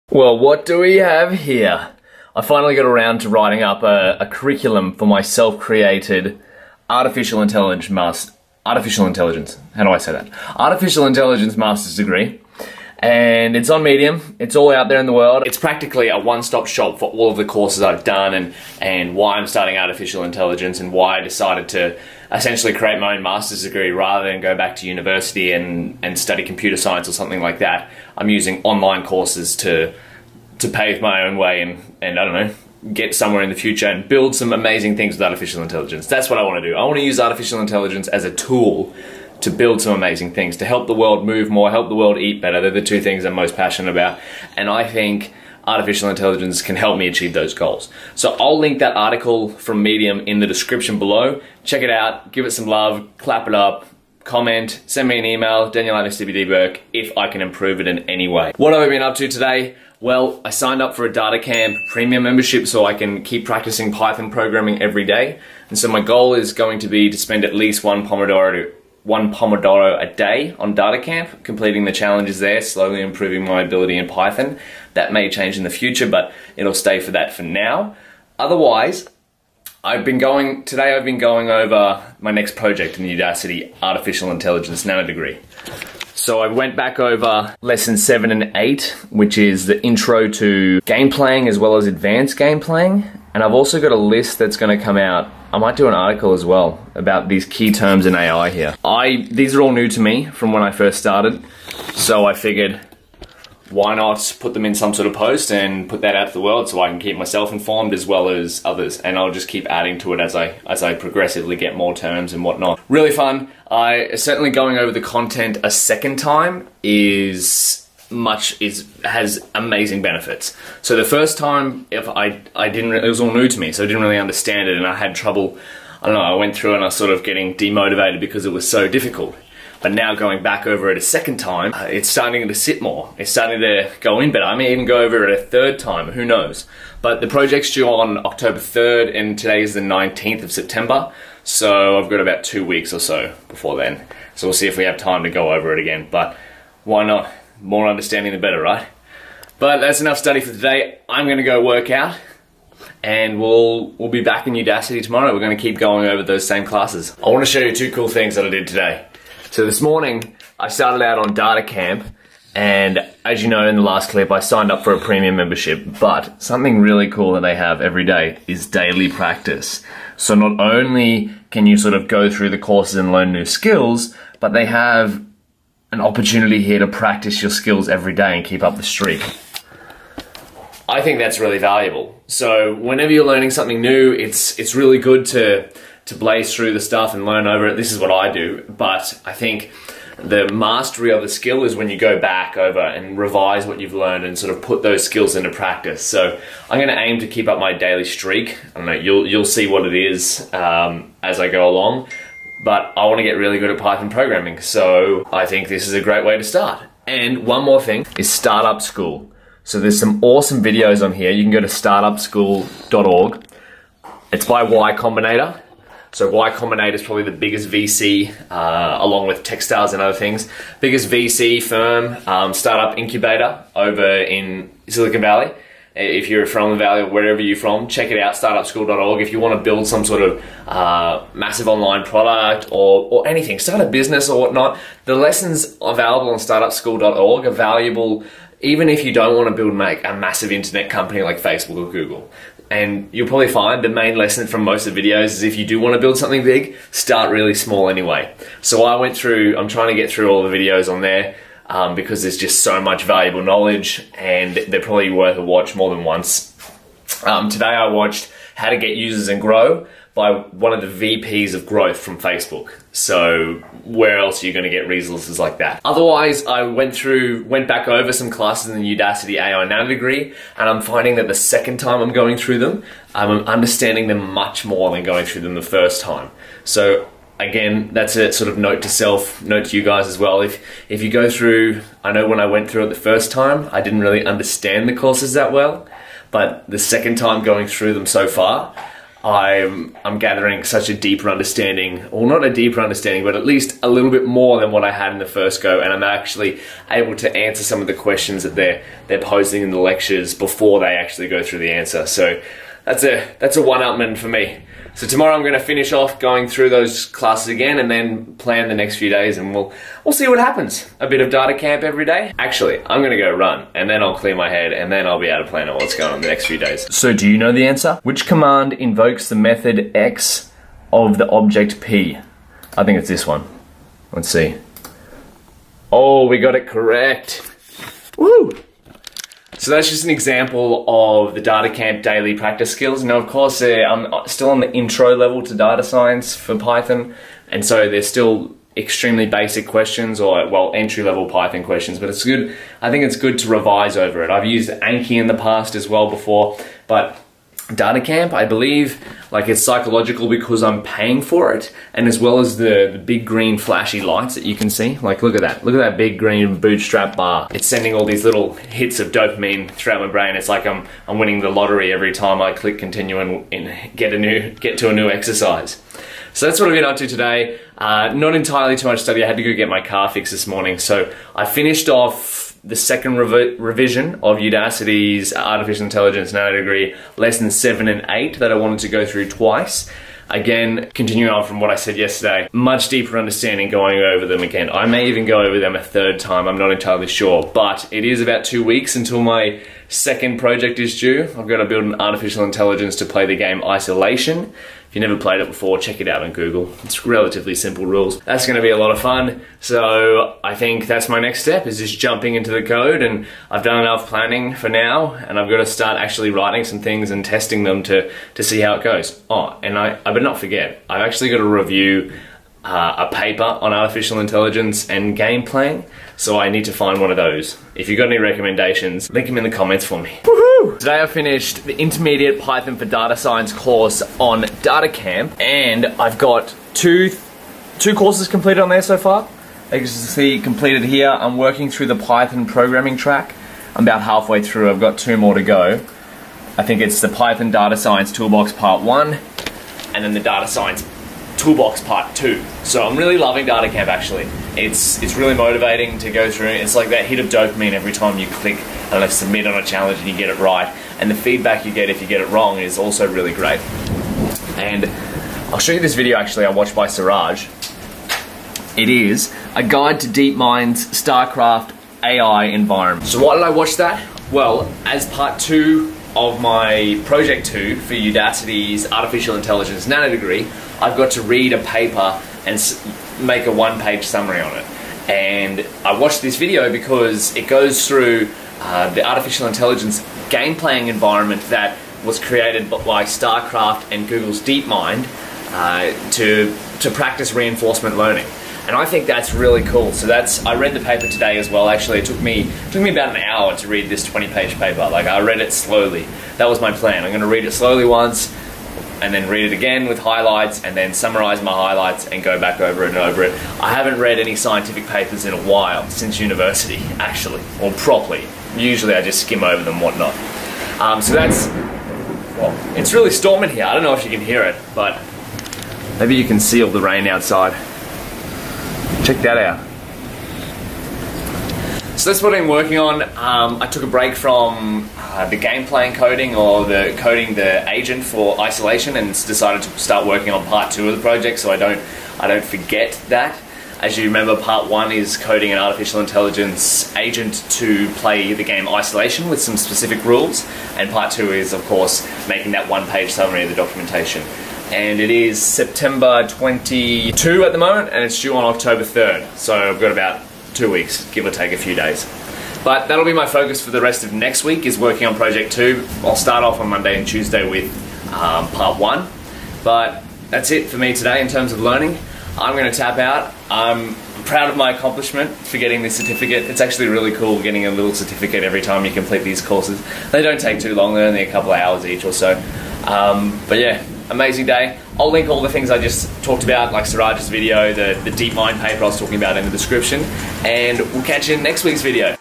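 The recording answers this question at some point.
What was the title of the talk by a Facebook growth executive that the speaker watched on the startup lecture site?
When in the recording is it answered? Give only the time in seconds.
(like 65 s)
258 s.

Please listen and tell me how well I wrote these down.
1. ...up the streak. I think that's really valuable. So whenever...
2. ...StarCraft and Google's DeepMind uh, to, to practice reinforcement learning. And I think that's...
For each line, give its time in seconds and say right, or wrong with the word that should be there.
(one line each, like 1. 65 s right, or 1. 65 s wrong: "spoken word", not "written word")
1. 178 s right
2. 483 s right.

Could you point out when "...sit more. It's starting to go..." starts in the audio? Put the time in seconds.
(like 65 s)
132 s.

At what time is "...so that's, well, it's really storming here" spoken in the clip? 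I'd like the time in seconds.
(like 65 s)
511 s.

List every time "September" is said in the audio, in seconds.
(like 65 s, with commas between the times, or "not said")
140 s, 545 s.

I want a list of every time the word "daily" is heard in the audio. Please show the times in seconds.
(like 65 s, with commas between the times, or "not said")
168 s, 197 s, 332 s.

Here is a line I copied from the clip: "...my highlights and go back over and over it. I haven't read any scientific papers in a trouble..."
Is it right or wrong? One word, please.
wrong.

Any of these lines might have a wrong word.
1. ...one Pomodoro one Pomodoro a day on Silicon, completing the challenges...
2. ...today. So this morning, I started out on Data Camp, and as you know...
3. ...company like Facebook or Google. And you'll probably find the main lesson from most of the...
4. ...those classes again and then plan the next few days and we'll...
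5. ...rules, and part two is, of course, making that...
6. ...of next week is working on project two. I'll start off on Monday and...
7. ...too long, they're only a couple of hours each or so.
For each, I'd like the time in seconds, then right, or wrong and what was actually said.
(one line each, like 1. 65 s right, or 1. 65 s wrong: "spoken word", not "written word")
1. 67 s wrong: "DataCamp", not "Silicon"
2. 158 s right
3. 240 s right
4. 306 s right
5. 540 s right
6. 554 s right
7. 570 s right.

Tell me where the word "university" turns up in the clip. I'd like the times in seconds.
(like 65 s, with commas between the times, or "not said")
24 s, 506 s.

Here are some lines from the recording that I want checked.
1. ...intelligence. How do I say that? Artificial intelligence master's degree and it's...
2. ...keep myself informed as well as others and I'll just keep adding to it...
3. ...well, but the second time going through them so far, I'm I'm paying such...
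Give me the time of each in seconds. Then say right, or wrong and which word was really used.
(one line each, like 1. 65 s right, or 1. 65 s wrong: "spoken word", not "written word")
1. 9 s right
2. 106 s right
3. 285 s wrong: "gathering", not "paying".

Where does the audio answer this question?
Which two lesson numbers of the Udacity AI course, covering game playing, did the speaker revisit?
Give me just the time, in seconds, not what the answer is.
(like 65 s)
87 s.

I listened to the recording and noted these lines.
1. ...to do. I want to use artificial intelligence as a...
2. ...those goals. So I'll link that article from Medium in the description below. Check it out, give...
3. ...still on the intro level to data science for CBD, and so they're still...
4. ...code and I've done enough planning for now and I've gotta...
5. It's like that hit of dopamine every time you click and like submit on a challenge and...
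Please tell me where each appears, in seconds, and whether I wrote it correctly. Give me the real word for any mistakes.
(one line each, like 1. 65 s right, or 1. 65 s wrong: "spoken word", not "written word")
1. 36 s right
2. 47 s right
3. 334 s wrong: "Python", not "CBD"
4. 402 s right
5. 446 s right.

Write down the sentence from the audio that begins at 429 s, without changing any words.
As you can see, completed here, I'm working through the Python programming track.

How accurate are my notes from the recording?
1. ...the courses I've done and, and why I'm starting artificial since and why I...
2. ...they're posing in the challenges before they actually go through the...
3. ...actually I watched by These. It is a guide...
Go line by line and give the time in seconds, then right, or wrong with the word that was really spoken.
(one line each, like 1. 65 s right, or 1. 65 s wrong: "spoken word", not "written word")
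1. 17 s wrong: "intelligence", not "since"
2. 299 s wrong: "lectures", not "challenges"
3. 456 s wrong: "Siraj", not "These".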